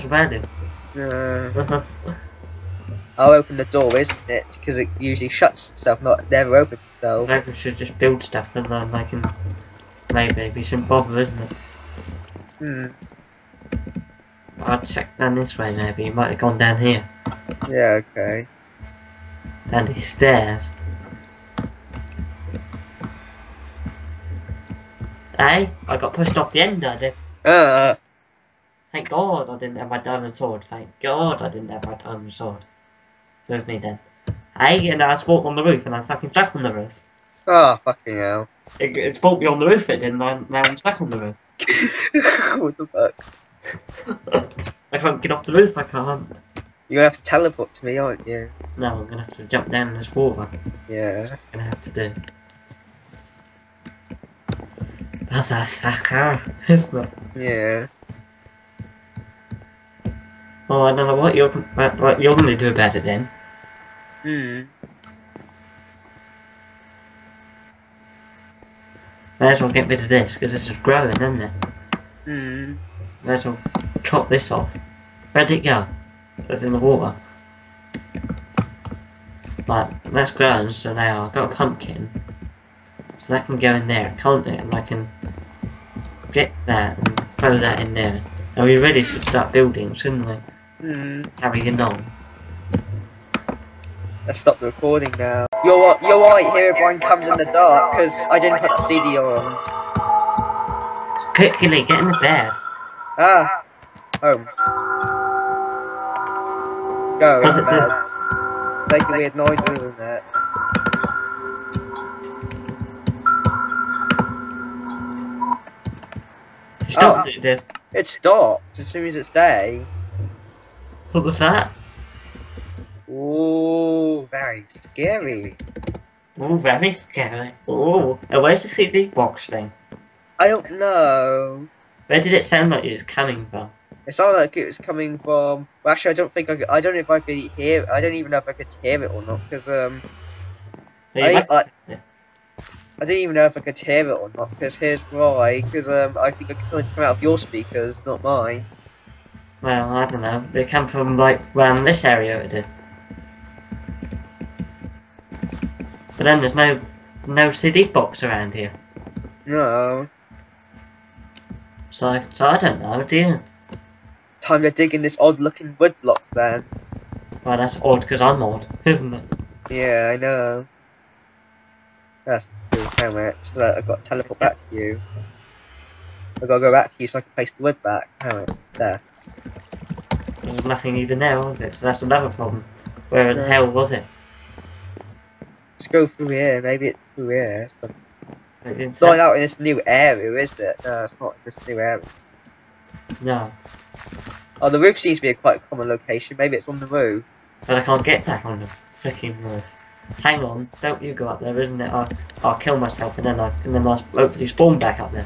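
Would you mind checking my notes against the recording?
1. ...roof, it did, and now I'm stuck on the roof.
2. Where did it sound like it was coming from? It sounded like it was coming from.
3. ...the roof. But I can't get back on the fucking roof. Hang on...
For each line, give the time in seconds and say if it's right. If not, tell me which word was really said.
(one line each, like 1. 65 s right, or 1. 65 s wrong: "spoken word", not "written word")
1. 39 s right
2. 132 s right
3. 196 s wrong: "freaking", not "fucking".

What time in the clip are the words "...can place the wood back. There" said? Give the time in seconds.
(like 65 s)
177 s.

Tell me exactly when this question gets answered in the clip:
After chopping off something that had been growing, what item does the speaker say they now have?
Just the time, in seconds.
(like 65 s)
81 s.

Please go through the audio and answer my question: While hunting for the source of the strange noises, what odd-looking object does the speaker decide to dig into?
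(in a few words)
Woodblock.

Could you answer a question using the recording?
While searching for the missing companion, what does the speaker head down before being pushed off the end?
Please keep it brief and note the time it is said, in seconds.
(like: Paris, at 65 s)
Stairs, at 20 s.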